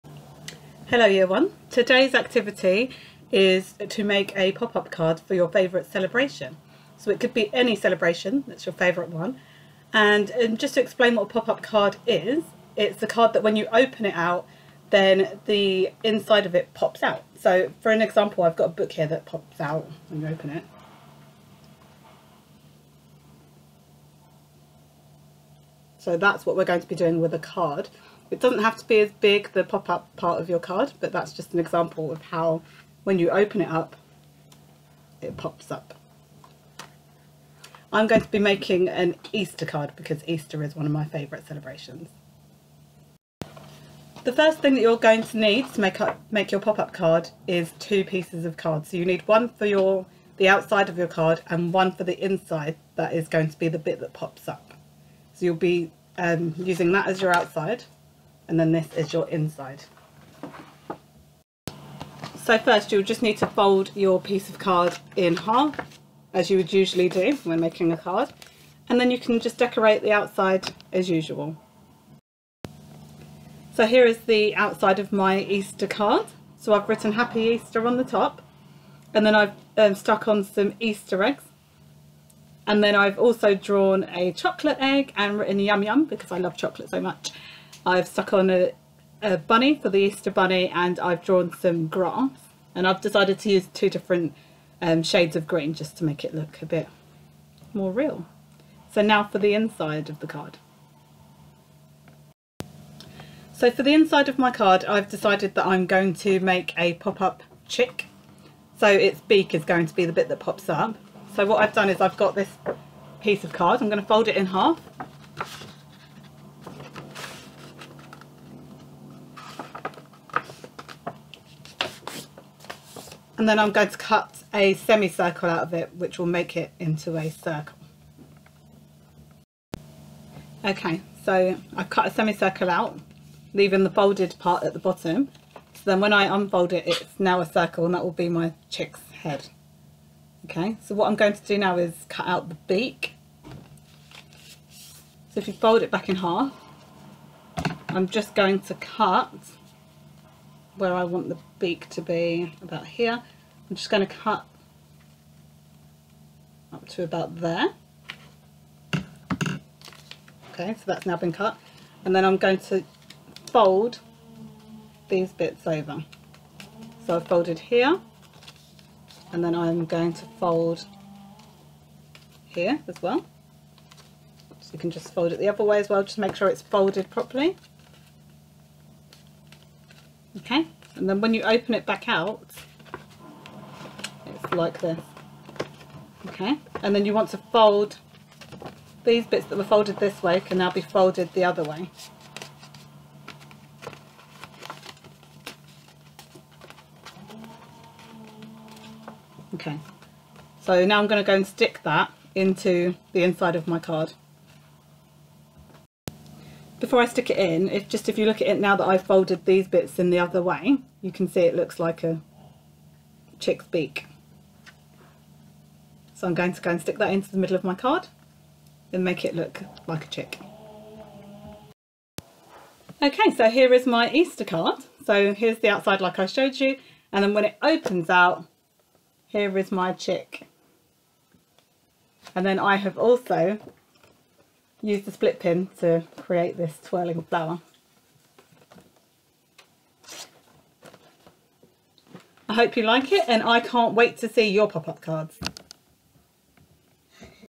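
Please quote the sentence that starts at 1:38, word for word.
So now for the inside of the card.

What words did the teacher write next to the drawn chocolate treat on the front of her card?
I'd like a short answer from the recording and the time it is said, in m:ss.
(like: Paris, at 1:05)
yum yum, at 1:25.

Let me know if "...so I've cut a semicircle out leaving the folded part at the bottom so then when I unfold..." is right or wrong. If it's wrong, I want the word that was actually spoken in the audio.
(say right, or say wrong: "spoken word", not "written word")
right.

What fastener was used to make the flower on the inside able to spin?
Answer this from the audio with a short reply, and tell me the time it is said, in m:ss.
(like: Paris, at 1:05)
split pin, at 3:55.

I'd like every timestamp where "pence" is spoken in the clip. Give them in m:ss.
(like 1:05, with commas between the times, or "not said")
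not said.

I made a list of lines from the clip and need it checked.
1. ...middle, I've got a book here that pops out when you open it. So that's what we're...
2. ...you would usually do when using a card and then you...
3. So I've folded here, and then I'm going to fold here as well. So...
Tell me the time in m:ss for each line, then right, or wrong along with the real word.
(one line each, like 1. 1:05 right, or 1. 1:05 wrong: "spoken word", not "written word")
1. 0:18 wrong: "example", not "middle"
2. 1:06 wrong: "making", not "using"
3. 2:47 right.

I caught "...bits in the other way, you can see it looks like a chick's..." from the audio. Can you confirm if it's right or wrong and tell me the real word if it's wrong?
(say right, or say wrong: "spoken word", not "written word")
right.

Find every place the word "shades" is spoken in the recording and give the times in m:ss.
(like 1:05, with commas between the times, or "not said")
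1:35.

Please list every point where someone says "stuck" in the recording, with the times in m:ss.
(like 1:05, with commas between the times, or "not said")
1:19, 1:28.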